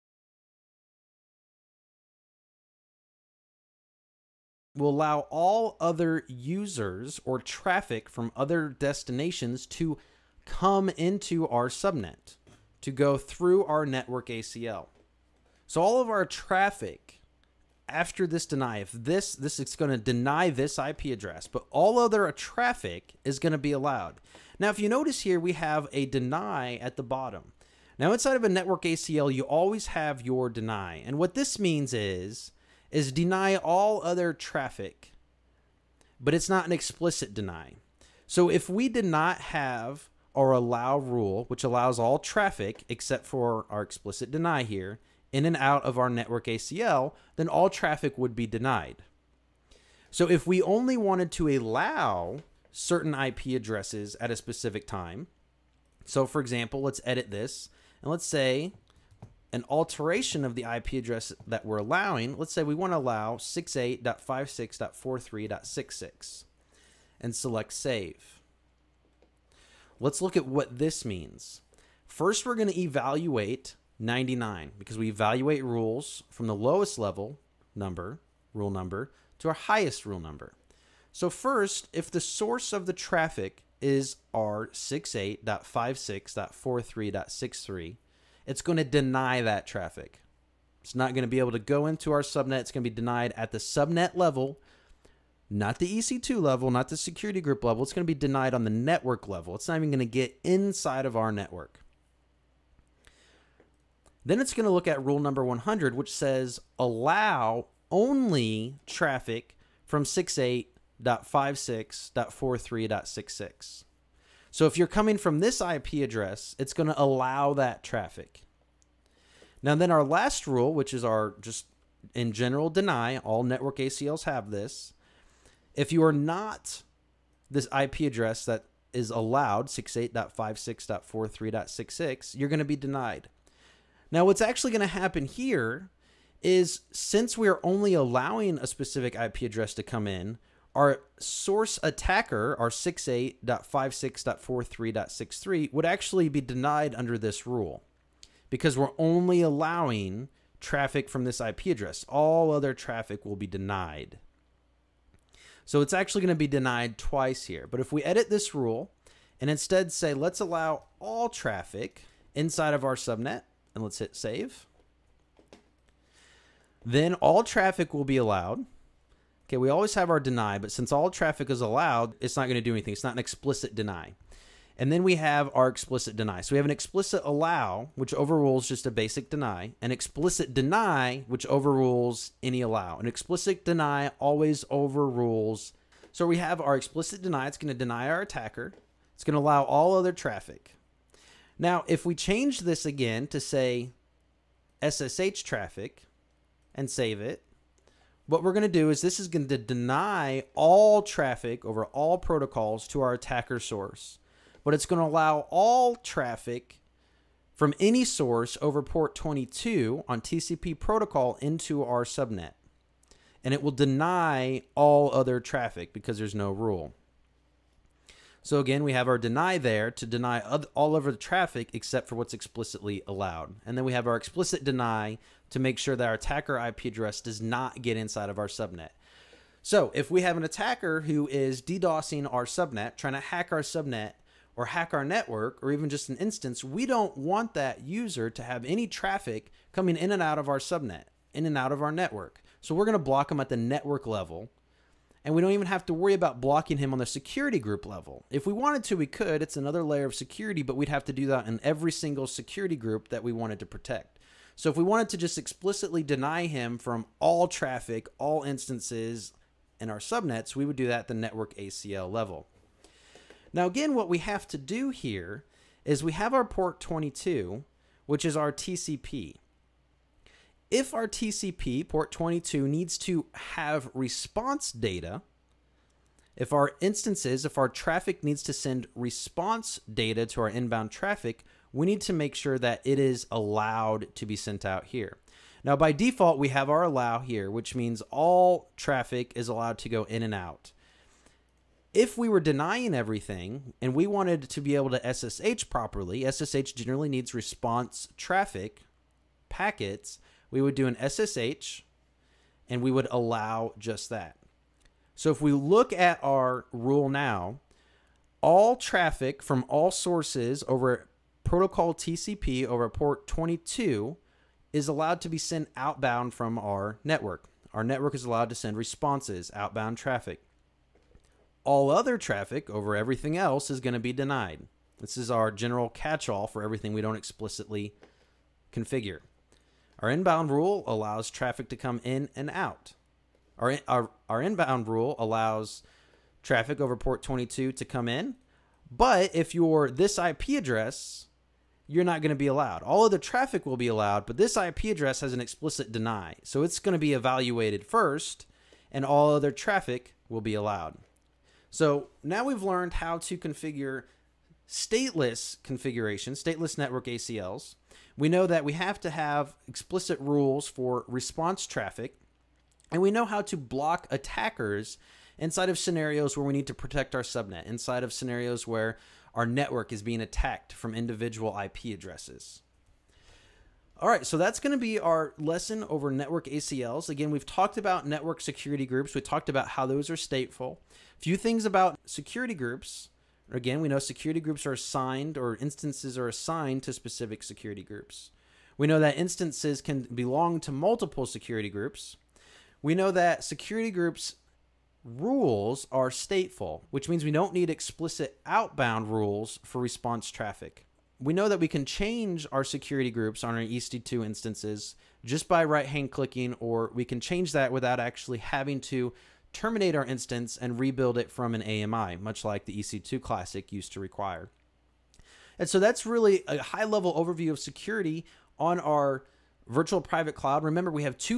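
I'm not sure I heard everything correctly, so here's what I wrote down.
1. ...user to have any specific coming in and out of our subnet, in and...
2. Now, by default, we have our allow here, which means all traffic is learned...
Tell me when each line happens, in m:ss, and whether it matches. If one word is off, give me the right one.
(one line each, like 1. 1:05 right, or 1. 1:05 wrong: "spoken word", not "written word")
1. 3:57 wrong: "traffic", not "specific"
2. 4:45 wrong: "allowed", not "learned".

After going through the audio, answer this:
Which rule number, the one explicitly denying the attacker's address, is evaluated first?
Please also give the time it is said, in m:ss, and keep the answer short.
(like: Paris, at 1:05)
99, at 1:13.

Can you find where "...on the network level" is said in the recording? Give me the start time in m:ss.
1:38.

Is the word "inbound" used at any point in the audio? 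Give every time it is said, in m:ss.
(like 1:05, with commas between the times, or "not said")
4:40, 5:30, 5:34.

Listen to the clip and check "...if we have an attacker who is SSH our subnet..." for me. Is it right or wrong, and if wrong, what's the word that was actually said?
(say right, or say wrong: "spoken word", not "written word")
wrong: "DDoSing", not "SSH".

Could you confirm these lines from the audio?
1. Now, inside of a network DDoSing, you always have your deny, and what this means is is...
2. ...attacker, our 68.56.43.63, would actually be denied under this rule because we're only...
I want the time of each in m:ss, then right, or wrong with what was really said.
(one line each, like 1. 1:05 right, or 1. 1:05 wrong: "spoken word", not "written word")
1. 0:27 wrong: "ACL", not "DDoSing"
2. 2:21 right.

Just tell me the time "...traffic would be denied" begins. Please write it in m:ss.
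0:47.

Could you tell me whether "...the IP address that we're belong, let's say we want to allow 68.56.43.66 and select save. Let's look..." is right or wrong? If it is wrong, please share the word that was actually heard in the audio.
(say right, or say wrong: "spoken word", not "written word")
wrong: "allowing", not "belong".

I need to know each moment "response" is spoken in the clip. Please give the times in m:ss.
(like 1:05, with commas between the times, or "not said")
4:33, 4:38, 4:57, 5:18, 6:01, 6:39.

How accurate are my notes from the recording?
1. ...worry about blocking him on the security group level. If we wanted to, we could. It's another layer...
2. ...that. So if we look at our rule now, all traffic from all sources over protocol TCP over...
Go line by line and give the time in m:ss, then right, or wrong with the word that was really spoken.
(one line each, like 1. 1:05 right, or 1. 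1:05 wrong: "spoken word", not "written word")
1. 4:05 right
2. 5:04 right.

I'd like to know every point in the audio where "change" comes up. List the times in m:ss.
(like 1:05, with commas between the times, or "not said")
3:12, 6:41, 6:47.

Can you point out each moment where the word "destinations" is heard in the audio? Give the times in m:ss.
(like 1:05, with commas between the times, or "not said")
0:08.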